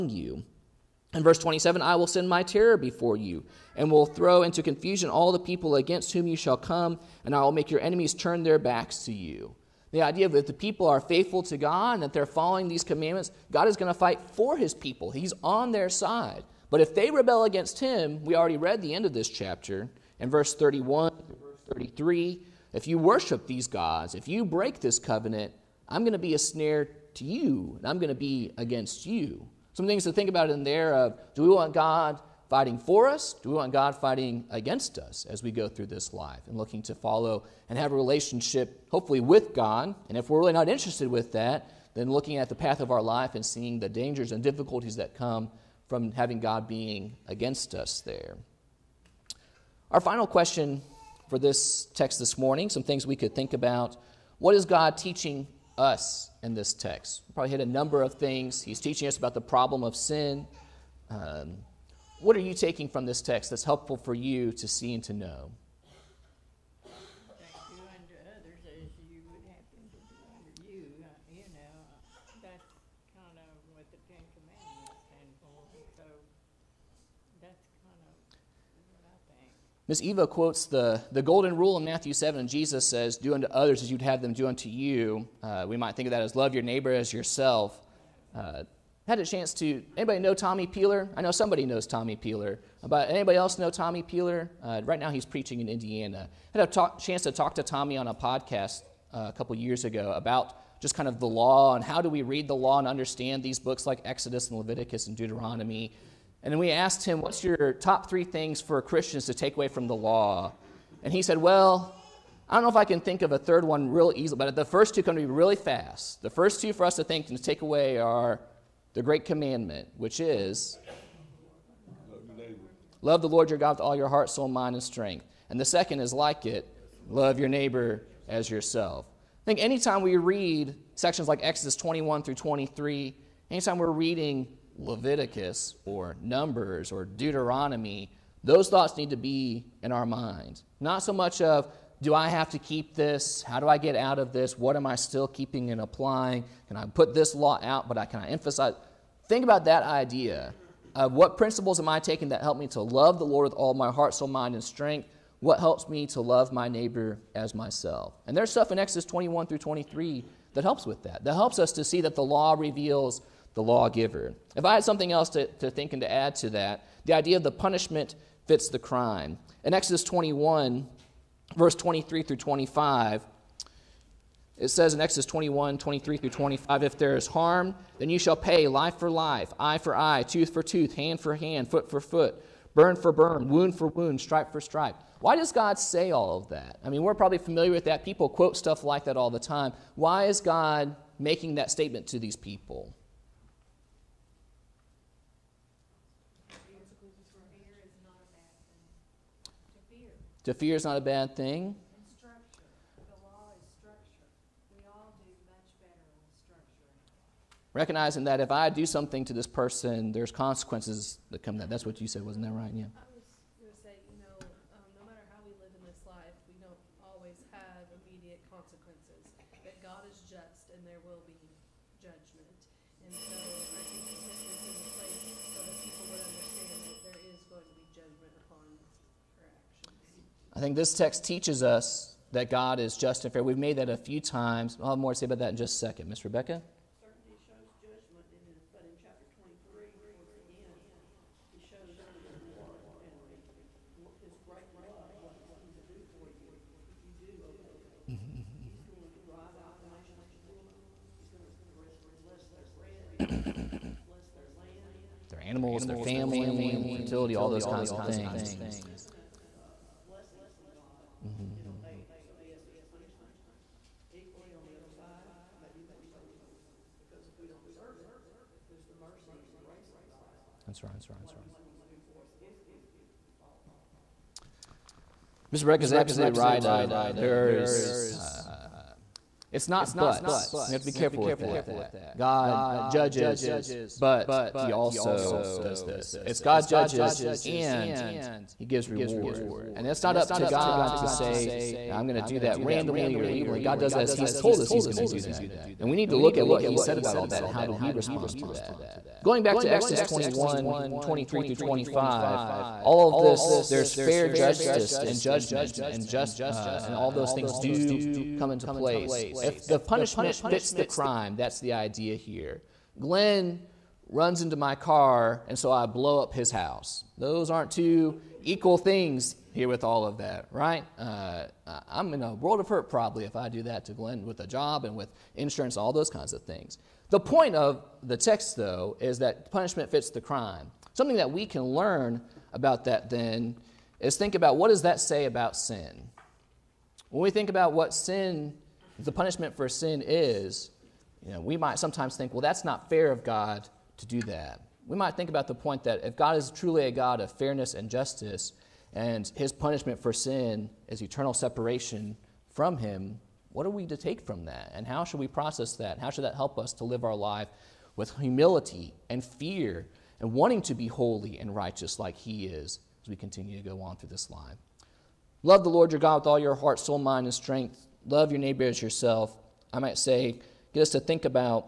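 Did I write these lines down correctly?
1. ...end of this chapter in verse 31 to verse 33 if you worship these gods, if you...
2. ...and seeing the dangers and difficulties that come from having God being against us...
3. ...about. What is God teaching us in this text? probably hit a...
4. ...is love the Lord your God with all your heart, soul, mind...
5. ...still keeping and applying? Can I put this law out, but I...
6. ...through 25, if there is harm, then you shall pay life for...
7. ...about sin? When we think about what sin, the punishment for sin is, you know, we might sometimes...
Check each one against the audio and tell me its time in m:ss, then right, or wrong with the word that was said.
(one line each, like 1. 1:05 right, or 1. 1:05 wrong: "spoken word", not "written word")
1. 0:18 right
2. 0:43 right
3. 0:53 right
4. 2:00 right
5. 2:24 right
6. 2:56 right
7. 5:35 right.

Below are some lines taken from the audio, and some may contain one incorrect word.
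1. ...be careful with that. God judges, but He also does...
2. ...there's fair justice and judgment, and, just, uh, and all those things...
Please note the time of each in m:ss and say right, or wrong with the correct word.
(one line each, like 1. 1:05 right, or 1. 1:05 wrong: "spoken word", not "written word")
1. 4:40 right
2. 5:03 right.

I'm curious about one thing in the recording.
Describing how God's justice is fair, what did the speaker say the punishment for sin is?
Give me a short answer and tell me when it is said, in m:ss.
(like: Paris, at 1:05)
Eternal separation, at 5:51.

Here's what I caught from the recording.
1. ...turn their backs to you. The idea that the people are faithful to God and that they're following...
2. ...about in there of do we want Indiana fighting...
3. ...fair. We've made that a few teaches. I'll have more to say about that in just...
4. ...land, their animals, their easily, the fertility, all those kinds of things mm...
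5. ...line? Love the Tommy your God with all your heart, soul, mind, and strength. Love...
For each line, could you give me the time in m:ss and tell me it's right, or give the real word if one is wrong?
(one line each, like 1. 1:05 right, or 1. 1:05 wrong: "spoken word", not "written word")
1. 0:08 right
2. 0:30 wrong: "God", not "Indiana"
3. 3:53 wrong: "times", not "teaches"
4. 4:14 wrong: "family", not "easily"
5. 6:04 wrong: "Lord", not "Tommy".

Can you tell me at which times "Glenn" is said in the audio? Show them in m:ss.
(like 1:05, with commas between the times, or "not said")
5:12, 5:23.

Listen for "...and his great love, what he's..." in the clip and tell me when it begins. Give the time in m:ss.
4:03.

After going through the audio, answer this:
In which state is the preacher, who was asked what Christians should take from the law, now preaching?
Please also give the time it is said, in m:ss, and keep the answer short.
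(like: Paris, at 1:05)
Indiana, at 1:35.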